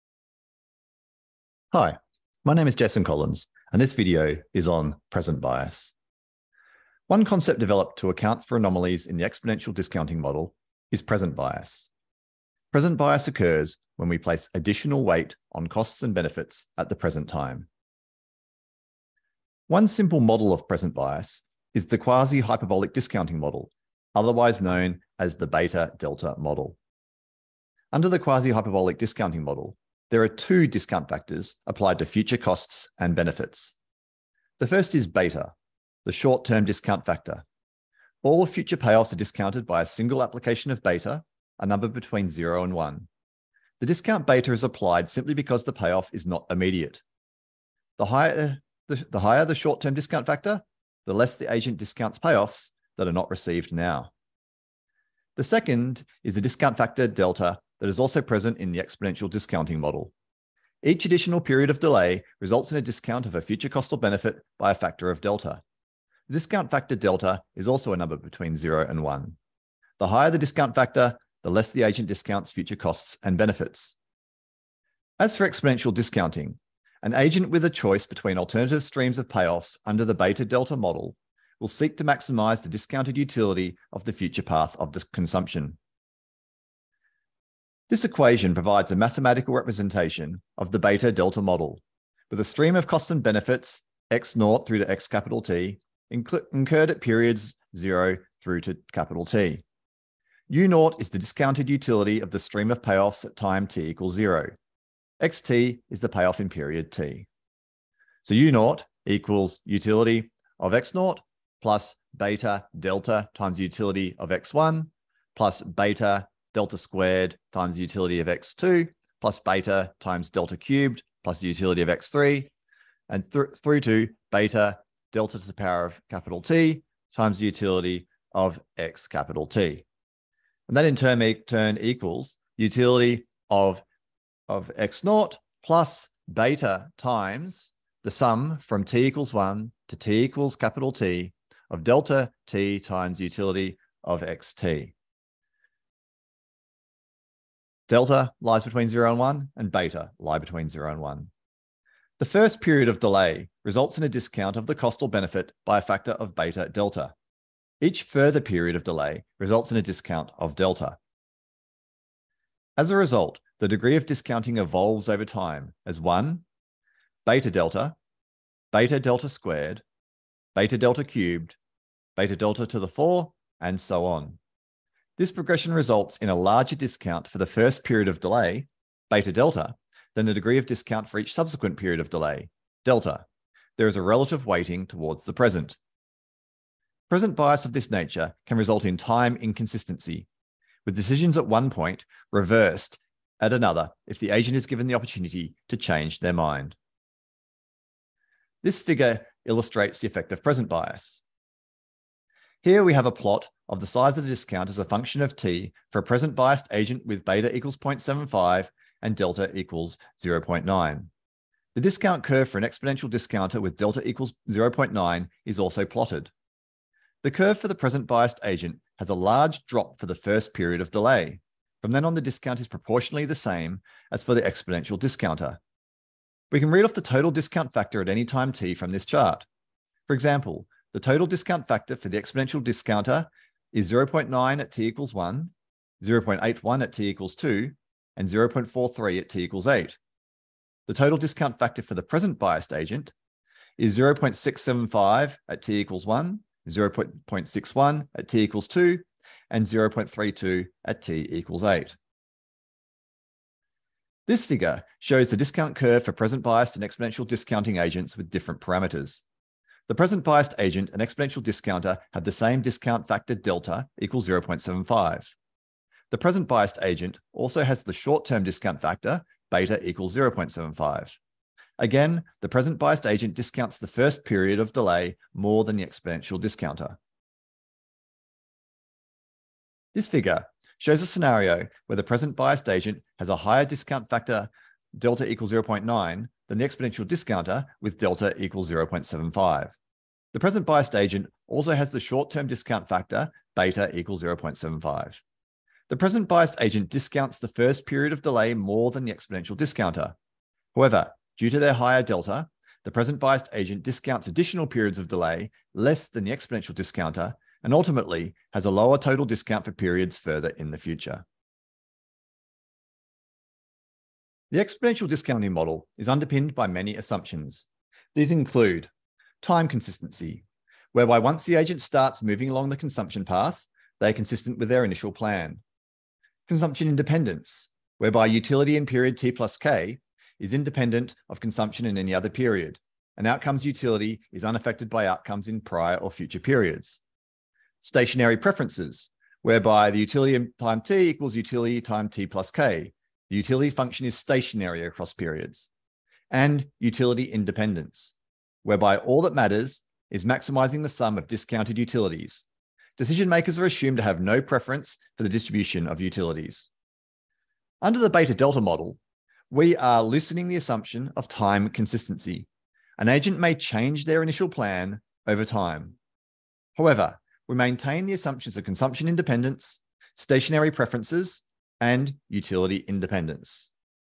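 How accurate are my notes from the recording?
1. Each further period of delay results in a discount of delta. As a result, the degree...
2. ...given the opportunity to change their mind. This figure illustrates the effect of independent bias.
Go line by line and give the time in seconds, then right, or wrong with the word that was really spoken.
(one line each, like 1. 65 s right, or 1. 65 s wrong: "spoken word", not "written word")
1. 157 s right
2. 194 s wrong: "present", not "independent".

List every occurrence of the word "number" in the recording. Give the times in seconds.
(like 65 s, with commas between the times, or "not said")
41 s, 67 s.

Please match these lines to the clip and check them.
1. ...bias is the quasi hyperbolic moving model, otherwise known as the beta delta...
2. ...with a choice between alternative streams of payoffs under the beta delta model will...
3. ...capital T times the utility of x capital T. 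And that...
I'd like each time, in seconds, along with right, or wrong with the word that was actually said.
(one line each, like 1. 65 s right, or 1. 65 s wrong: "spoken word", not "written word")
1. 20 s wrong: "discounting", not "moving"
2. 77 s right
3. 126 s right.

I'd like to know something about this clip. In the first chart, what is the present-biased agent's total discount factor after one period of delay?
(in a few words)
0.675.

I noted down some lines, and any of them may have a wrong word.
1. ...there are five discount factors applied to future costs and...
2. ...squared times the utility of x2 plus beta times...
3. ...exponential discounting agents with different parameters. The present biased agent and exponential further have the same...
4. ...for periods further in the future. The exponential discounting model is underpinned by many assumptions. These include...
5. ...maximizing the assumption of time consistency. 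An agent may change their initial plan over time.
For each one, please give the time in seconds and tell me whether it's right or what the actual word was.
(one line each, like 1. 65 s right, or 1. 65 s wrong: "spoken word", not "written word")
1. 30 s wrong: "two", not "five"
2. 116 s right
3. 256 s wrong: "discounter", not "further"
4. 309 s right
5. 360 s wrong: "loosening", not "maximizing".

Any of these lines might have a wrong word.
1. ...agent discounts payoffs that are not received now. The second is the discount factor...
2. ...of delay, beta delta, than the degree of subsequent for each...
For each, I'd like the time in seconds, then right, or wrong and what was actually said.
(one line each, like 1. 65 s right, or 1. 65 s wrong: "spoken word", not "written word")
1. 51 s right
2. 178 s wrong: "discount", not "subsequent".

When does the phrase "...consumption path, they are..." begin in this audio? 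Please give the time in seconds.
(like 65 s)
322 s.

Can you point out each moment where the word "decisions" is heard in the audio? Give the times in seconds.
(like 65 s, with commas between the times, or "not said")
190 s, 352 s.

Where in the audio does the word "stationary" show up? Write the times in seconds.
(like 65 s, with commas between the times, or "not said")
337 s, 344 s, 370 s.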